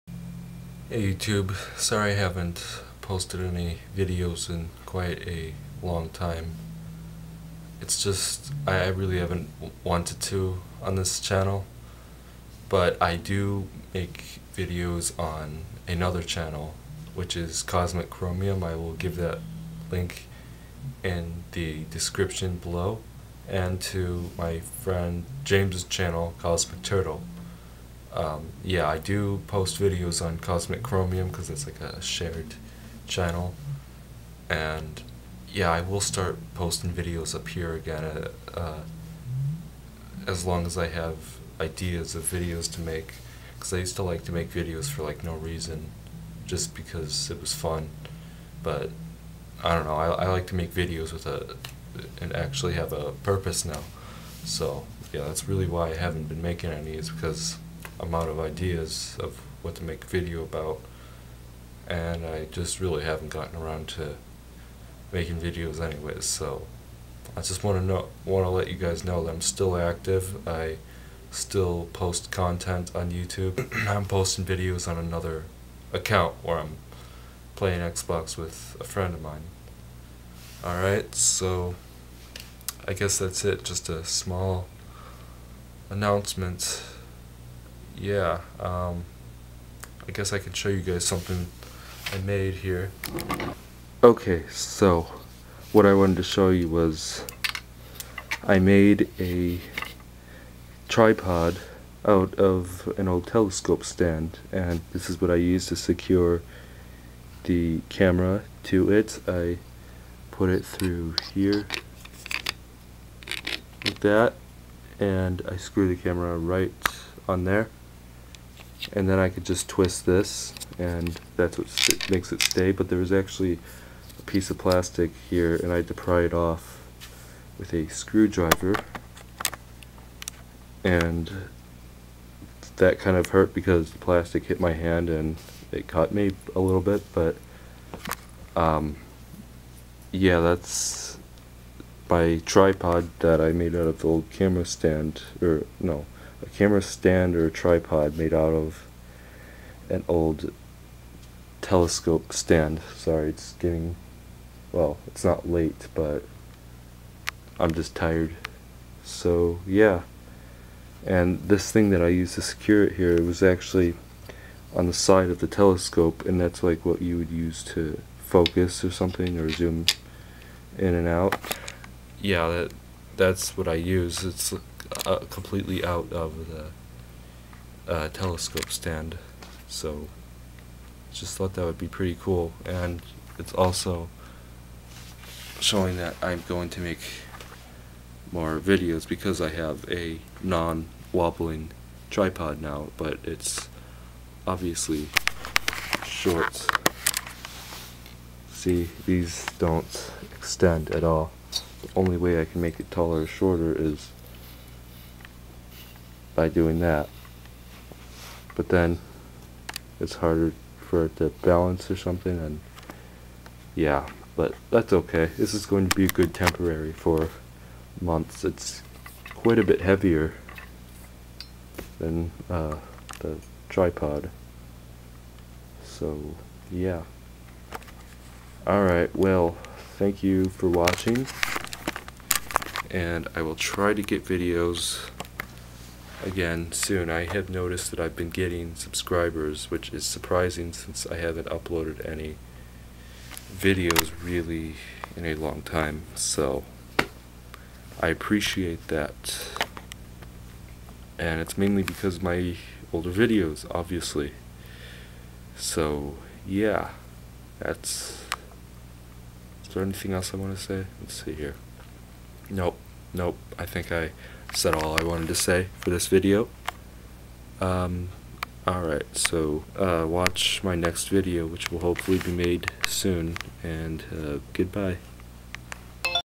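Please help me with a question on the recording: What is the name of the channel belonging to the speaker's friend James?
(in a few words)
Cosmic Turtle.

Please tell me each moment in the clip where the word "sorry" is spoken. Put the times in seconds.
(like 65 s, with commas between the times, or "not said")
1 s, 152 s.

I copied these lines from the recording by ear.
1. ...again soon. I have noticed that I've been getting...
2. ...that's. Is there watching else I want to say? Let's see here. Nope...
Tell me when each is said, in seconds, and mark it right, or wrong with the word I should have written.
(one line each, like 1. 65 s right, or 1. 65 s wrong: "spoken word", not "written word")
1. 236 s right
2. 257 s wrong: "anything", not "watching".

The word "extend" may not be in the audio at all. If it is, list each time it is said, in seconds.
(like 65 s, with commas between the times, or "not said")
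200 s.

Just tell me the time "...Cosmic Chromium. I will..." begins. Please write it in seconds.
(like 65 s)
17 s.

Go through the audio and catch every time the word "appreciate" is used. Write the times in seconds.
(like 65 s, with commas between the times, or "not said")
248 s.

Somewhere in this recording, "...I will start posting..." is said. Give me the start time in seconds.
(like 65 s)
35 s.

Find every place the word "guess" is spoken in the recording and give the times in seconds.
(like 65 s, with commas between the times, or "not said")
82 s, 90 s.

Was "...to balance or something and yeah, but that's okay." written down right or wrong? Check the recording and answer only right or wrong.
right.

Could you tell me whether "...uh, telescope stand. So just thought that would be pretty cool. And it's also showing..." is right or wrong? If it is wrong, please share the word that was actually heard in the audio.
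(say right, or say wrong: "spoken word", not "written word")
right.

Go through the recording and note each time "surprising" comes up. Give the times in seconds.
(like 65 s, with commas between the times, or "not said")
240 s.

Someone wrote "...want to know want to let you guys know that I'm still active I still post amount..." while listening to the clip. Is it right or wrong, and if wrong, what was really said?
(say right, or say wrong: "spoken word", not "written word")
wrong: "content", not "amount".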